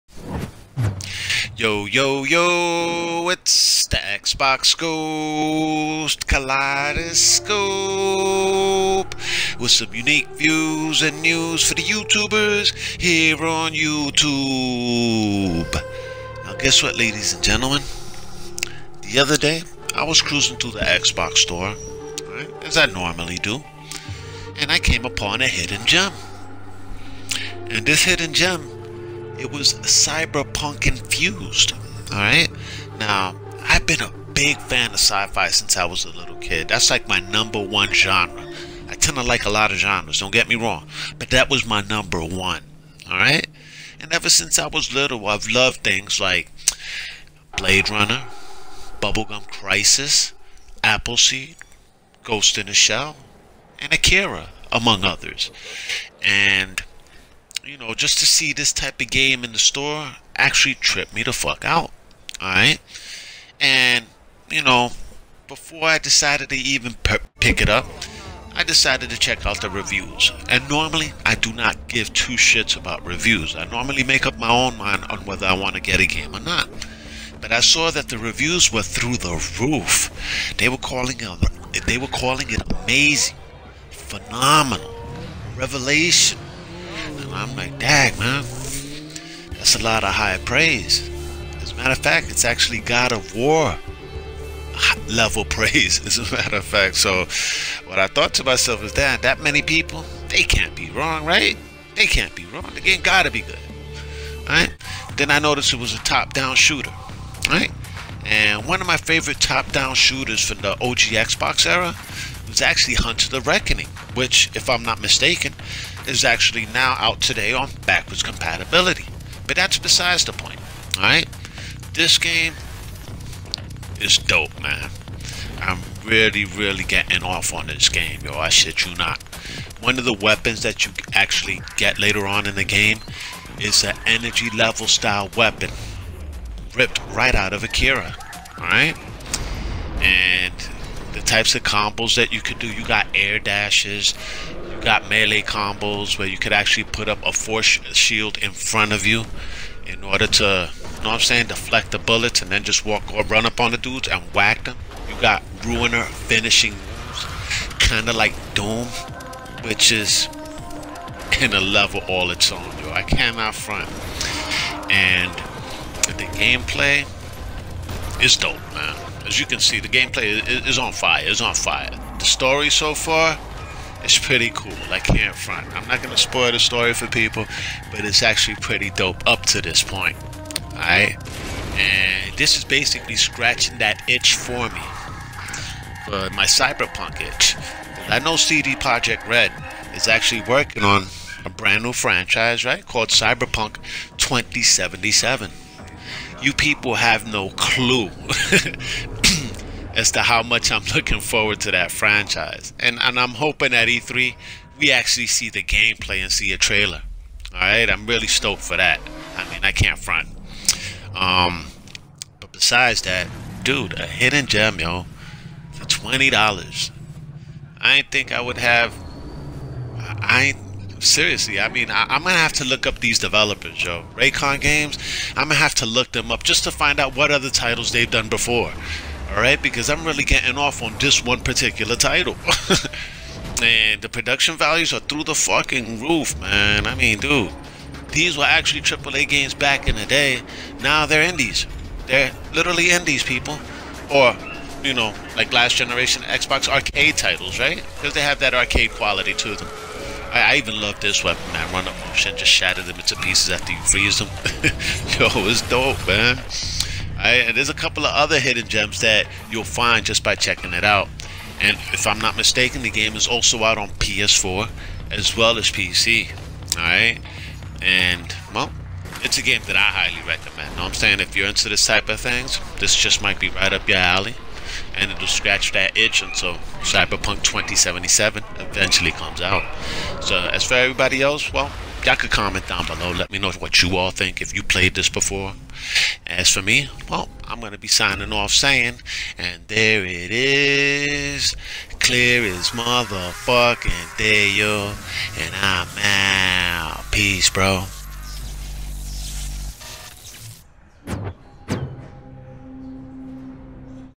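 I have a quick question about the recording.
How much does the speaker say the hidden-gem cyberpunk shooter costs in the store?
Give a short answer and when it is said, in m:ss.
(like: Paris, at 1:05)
$20, at 3:35.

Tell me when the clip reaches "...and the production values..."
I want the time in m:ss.
3:53.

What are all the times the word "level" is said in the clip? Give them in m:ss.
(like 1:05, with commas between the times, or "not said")
1:35, 2:14, 2:41.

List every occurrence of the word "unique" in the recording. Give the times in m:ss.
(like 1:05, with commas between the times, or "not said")
0:09.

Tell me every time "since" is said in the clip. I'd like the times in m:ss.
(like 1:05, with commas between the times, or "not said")
0:35, 0:44.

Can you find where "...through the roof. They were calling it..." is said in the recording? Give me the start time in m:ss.
1:18.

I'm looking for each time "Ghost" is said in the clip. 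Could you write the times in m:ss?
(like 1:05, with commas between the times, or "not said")
0:04, 0:52.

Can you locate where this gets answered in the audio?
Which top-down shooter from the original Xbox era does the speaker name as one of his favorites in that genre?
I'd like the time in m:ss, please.
1:52.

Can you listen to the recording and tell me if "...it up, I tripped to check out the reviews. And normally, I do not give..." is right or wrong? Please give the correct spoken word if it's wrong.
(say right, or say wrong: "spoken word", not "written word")
wrong: "decided", not "tripped".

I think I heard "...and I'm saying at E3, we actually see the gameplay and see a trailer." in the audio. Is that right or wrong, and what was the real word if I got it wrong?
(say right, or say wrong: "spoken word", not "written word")
wrong: "hoping", not "saying".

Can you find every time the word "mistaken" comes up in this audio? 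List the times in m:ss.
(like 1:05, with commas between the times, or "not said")
1:55, 4:22.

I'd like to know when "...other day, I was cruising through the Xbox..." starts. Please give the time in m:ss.
0:19.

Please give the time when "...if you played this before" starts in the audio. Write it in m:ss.
4:44.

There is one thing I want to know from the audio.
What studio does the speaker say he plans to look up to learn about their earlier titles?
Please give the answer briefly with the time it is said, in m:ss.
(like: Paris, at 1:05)
Reikon Games, at 3:44.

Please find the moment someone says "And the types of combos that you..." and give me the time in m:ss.
2:19.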